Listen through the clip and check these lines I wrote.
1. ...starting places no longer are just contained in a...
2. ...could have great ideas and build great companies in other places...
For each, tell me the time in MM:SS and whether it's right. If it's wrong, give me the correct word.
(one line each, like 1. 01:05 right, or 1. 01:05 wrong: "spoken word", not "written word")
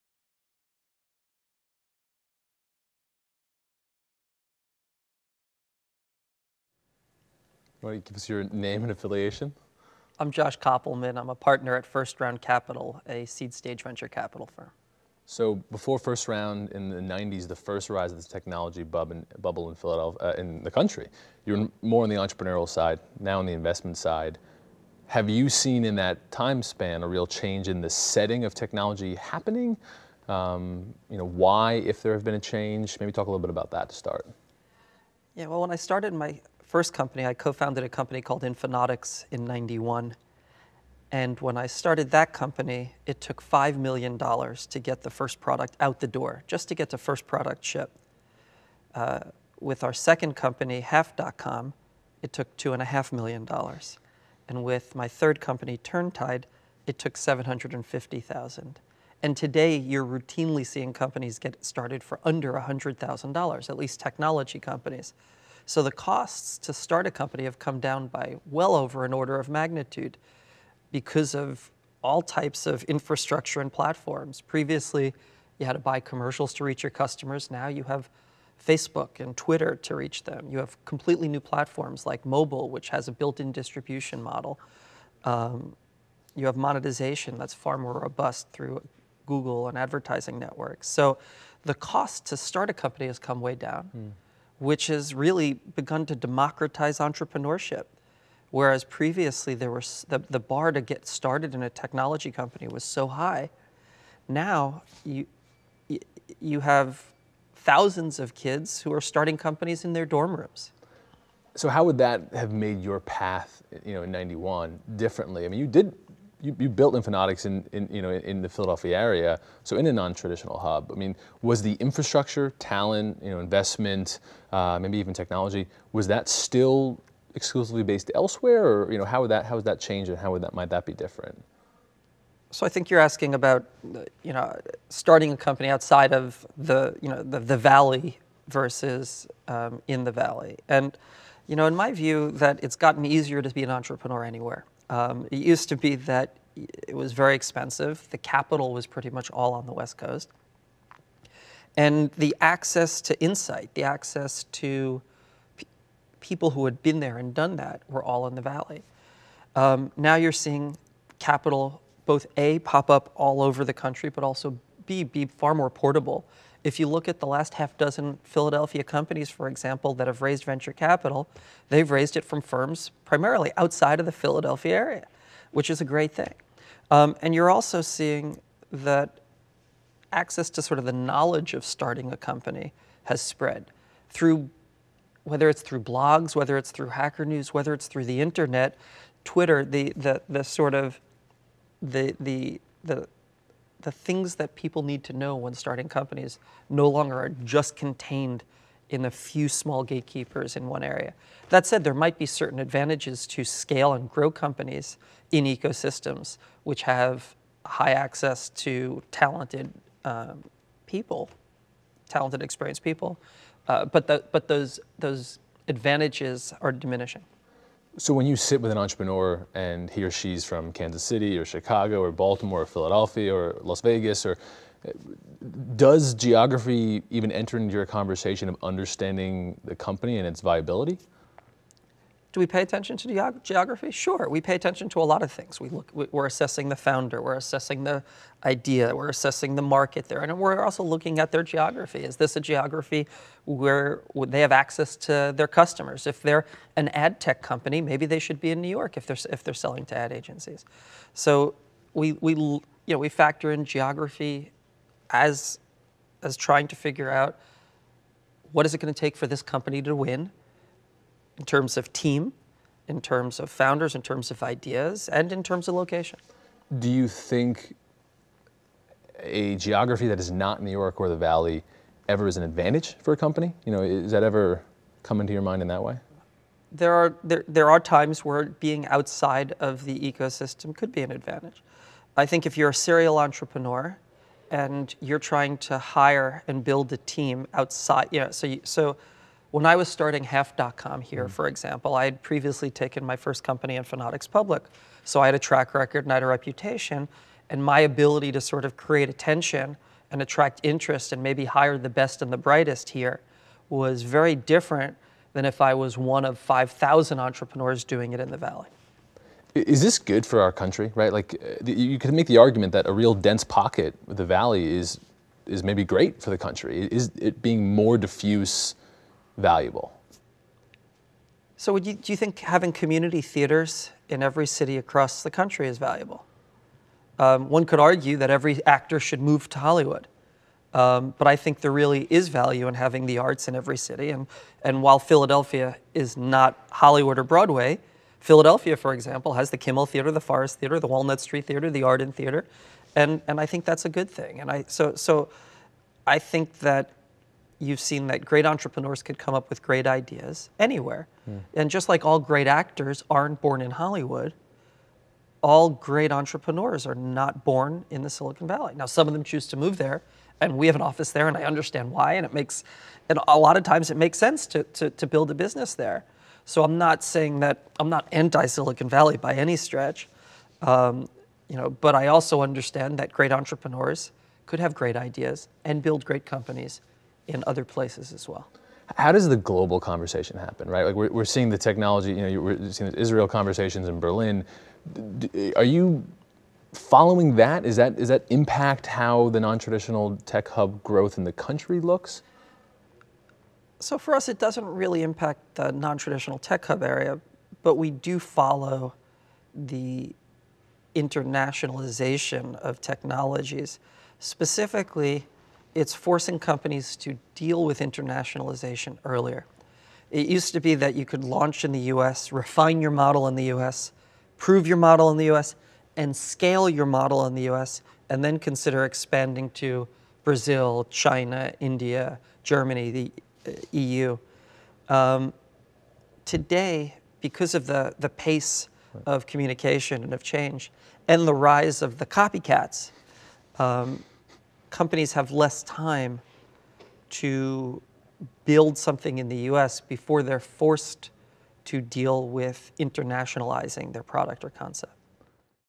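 1. 03:15 wrong: "companies", not "places"
2. 06:14 right.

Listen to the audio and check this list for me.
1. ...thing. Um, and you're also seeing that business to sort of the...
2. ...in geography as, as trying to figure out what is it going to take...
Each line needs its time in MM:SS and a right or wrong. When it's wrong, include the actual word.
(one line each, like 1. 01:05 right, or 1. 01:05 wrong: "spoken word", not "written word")
1. 02:56 wrong: "access", not "business"
2. 04:13 right.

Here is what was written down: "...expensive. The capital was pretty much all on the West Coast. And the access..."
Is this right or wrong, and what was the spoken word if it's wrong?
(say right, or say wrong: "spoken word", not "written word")
right.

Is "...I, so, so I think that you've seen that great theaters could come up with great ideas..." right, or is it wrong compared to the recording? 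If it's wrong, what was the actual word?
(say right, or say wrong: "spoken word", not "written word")
wrong: "entrepreneurs", not "theaters".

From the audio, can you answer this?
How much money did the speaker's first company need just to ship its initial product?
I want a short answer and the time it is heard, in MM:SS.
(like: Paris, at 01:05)
$5 million, at 00:43.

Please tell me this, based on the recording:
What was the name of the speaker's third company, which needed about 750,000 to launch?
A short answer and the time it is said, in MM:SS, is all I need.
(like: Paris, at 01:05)
Turntide, at 00:55.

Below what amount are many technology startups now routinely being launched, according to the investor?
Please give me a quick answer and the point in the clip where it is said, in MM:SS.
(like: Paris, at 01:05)
$100,000, at 01:02.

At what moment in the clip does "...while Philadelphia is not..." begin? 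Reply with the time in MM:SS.
05:34.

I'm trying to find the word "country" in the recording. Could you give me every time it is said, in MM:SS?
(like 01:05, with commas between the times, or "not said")
00:20, 02:43, 05:10, 05:16, 05:25, 06:31.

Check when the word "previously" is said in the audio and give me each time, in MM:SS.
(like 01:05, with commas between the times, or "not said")
01:14, 01:38, 04:52.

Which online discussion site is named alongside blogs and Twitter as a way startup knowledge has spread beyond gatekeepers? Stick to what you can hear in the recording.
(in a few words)
Hacker News.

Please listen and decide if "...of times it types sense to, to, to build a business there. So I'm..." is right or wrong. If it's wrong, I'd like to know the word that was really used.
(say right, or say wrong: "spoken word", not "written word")
wrong: "makes", not "types".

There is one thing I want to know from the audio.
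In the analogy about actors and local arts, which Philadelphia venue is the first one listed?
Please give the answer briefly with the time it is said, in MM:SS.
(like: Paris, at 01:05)
Kimmel Theater, at 05:39.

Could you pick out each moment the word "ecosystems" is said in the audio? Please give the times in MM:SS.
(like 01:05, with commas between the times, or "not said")
03:25, 04:39.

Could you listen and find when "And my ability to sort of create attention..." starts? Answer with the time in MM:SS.
04:57.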